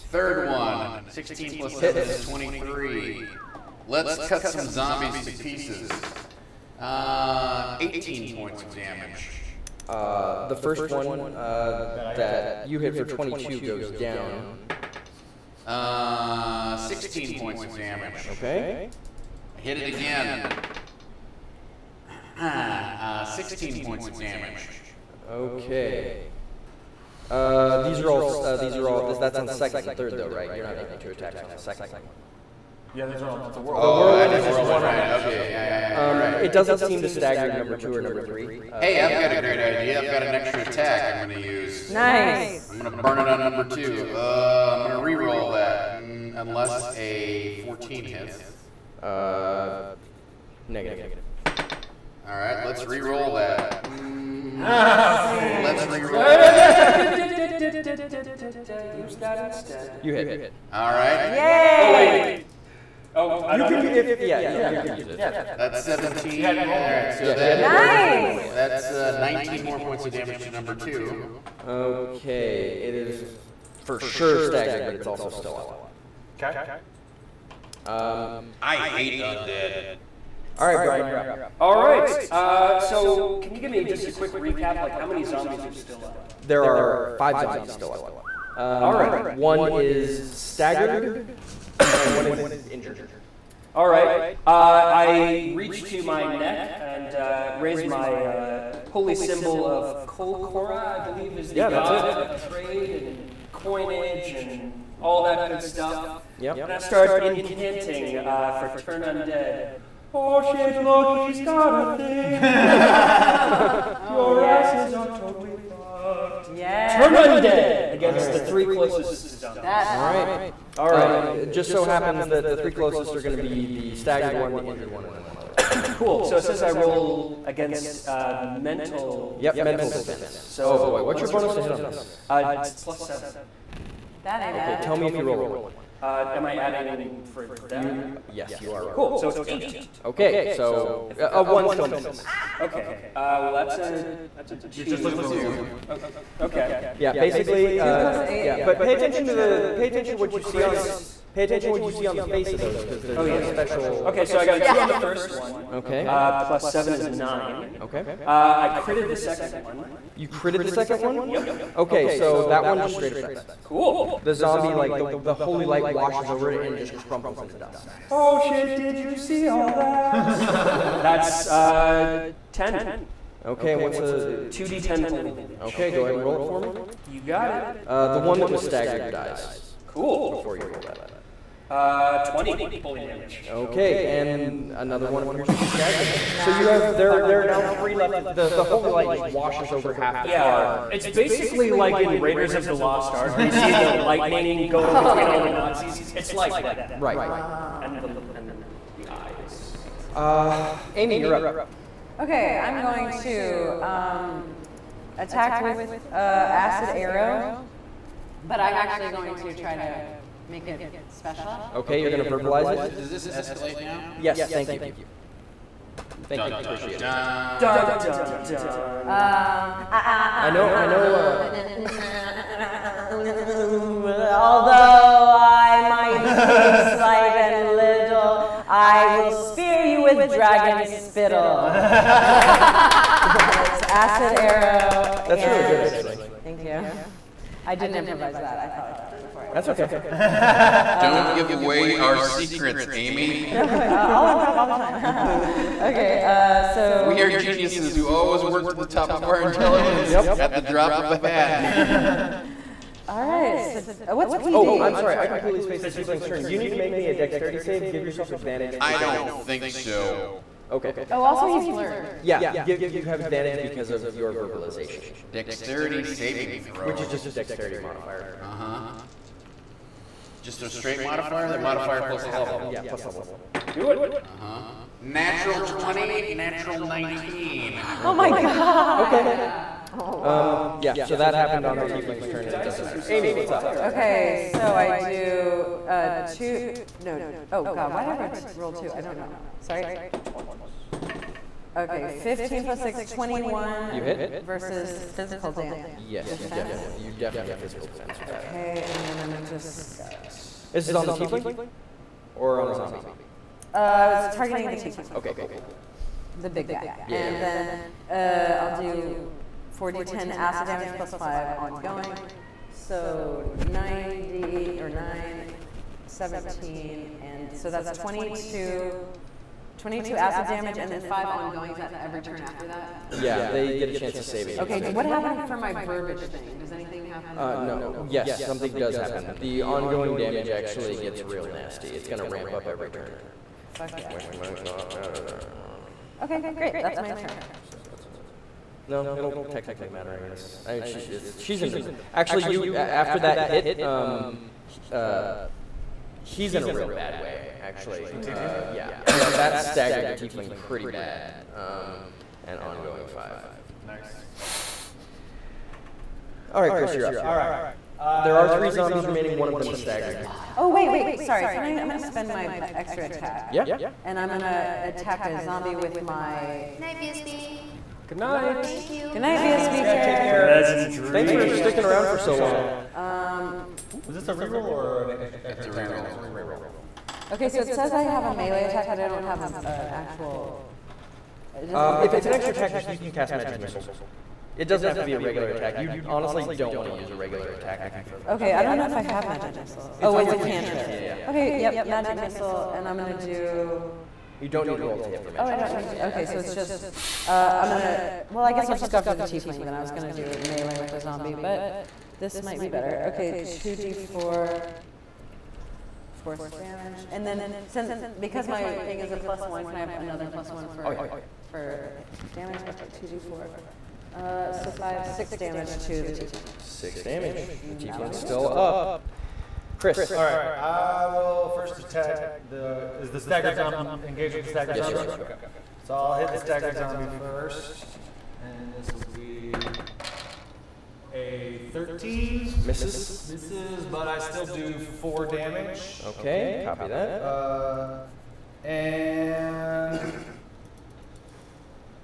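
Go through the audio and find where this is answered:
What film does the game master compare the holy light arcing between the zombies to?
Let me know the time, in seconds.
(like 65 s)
192 s.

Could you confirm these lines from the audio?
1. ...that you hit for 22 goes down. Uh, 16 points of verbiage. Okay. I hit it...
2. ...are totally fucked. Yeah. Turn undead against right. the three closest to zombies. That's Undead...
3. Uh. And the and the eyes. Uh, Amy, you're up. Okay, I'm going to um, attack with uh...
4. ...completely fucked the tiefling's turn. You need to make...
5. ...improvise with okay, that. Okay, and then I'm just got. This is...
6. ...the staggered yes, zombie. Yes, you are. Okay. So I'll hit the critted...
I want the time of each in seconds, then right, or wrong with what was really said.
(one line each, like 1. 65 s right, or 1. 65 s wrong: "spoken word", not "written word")
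1. 12 s wrong: "damage", not "verbiage"
2. 114 s wrong: "All", not "Undead"
3. 197 s right
4. 255 s wrong: "spaced", not "fucked"
5. 297 s wrong: "defense", not "improvise"
6. 424 s wrong: "staggered", not "critted".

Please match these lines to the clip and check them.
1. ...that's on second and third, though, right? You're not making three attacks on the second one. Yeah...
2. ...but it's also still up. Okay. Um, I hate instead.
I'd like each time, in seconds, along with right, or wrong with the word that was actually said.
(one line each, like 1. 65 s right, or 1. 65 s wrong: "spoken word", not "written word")
1. 29 s wrong: "two", not "three"
2. 74 s wrong: "undead", not "instead".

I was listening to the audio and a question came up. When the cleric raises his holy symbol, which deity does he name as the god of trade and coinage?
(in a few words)
Kolkora.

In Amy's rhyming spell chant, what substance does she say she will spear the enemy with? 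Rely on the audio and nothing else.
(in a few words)
dragon spittle.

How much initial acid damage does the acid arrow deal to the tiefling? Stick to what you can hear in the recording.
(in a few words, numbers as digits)
22.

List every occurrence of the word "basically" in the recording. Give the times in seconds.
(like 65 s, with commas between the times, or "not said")
147 s, 191 s.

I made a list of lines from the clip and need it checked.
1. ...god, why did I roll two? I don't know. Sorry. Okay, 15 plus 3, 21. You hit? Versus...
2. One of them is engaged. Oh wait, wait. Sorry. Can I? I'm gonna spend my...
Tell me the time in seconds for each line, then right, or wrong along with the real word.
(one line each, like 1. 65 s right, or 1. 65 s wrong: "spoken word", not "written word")
1. 287 s wrong: "6", not "3"
2. 359 s wrong: "staggered", not "engaged".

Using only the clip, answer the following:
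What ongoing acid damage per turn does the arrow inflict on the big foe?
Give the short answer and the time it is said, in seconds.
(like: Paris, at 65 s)
5, at 311 s.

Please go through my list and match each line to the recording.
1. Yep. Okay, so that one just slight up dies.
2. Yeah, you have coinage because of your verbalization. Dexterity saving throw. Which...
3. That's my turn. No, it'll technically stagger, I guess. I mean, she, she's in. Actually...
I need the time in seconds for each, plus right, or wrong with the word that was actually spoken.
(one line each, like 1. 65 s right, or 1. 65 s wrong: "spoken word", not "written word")
1. 161 s wrong: "straight", not "slight"
2. 262 s wrong: "advantage", not "coinage"
3. 336 s wrong: "matter", not "stagger".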